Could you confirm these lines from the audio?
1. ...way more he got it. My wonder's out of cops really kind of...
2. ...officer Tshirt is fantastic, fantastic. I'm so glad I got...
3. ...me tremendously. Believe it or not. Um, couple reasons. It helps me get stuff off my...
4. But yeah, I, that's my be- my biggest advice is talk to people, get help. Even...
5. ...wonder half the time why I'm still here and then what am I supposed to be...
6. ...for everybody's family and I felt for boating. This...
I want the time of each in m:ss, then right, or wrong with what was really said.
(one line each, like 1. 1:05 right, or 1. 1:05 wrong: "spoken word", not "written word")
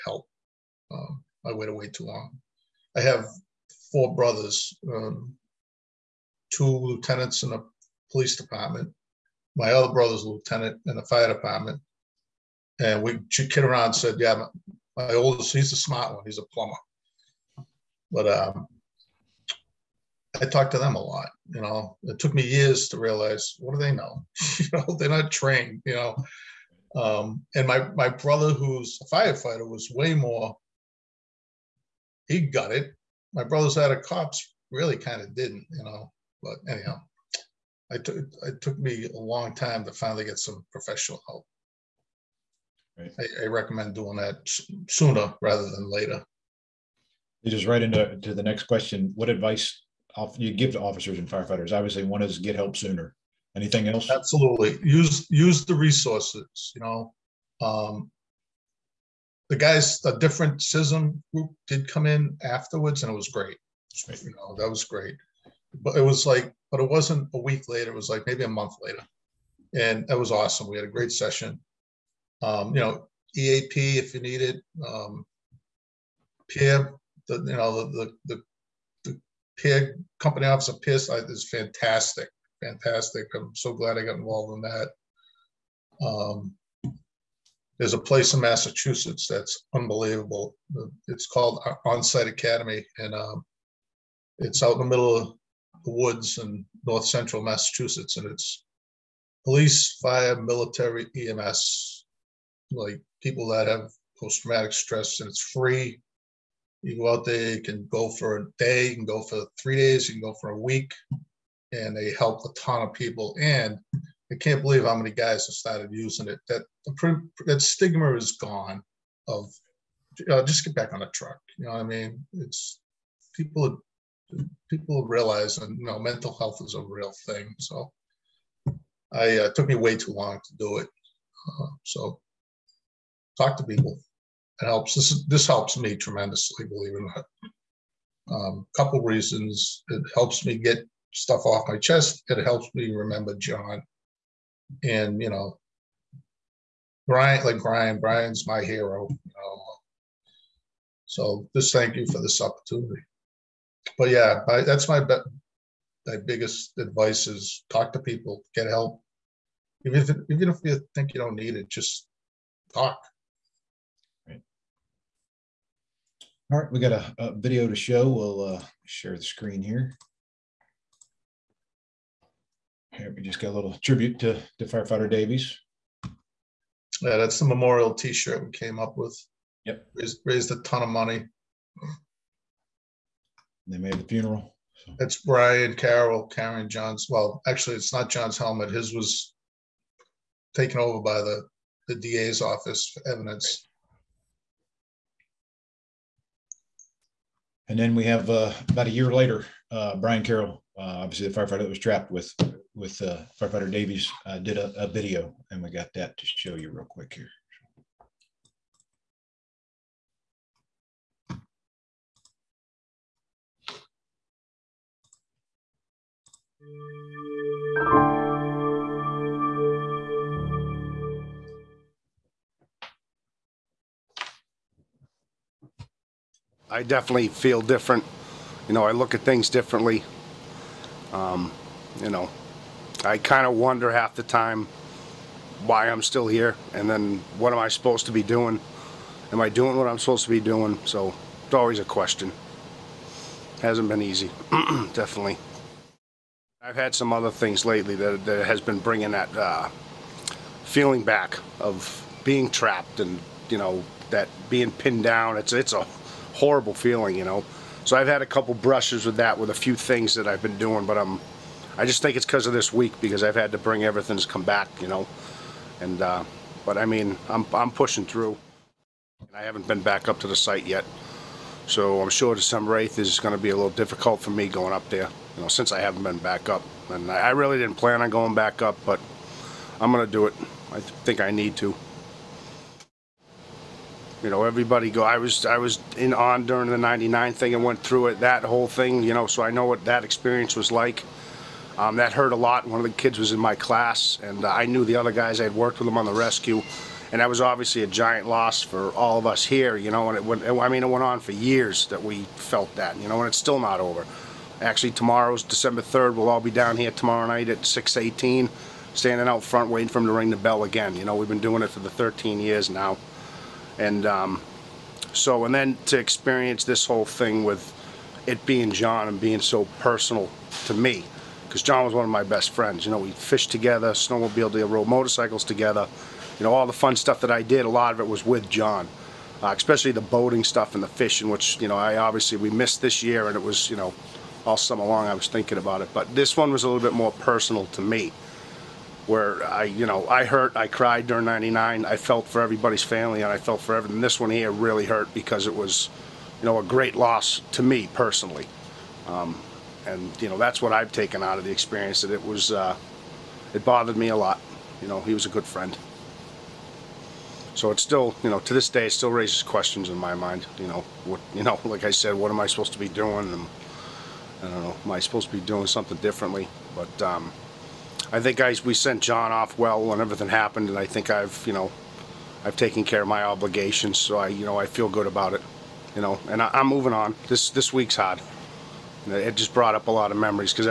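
1. 0:29 wrong: "brother", not "wonder"
2. 1:20 wrong: "PIS", not "Tshirt"
3. 2:15 right
4. 2:33 right
5. 3:53 right
6. 5:42 wrong: "everything", not "boating".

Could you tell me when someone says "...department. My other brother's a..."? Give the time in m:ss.
0:08.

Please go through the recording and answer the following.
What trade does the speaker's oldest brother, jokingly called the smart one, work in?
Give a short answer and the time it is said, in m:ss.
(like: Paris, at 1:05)
Plumber, at 0:16.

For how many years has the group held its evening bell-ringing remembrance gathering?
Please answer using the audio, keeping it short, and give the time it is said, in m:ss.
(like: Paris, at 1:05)
13, at 5:11.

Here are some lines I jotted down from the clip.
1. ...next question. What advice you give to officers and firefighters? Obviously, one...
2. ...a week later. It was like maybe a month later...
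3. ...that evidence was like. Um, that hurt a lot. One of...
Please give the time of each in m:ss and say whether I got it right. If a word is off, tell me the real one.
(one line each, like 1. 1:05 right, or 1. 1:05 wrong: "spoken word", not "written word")
1. 0:48 right
2. 1:07 right
3. 4:49 wrong: "experience", not "evidence".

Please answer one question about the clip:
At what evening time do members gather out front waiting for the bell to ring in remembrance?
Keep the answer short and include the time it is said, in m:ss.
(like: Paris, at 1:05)
6:18, at 5:07.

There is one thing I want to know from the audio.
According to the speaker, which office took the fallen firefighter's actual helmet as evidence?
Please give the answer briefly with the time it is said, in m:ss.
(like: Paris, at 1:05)
The DA's office, at 3:11.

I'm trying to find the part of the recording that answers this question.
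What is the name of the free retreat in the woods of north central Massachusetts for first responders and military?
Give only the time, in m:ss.
1:31.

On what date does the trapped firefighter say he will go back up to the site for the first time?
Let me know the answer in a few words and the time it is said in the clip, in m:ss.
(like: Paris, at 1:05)
December 8th, at 4:32.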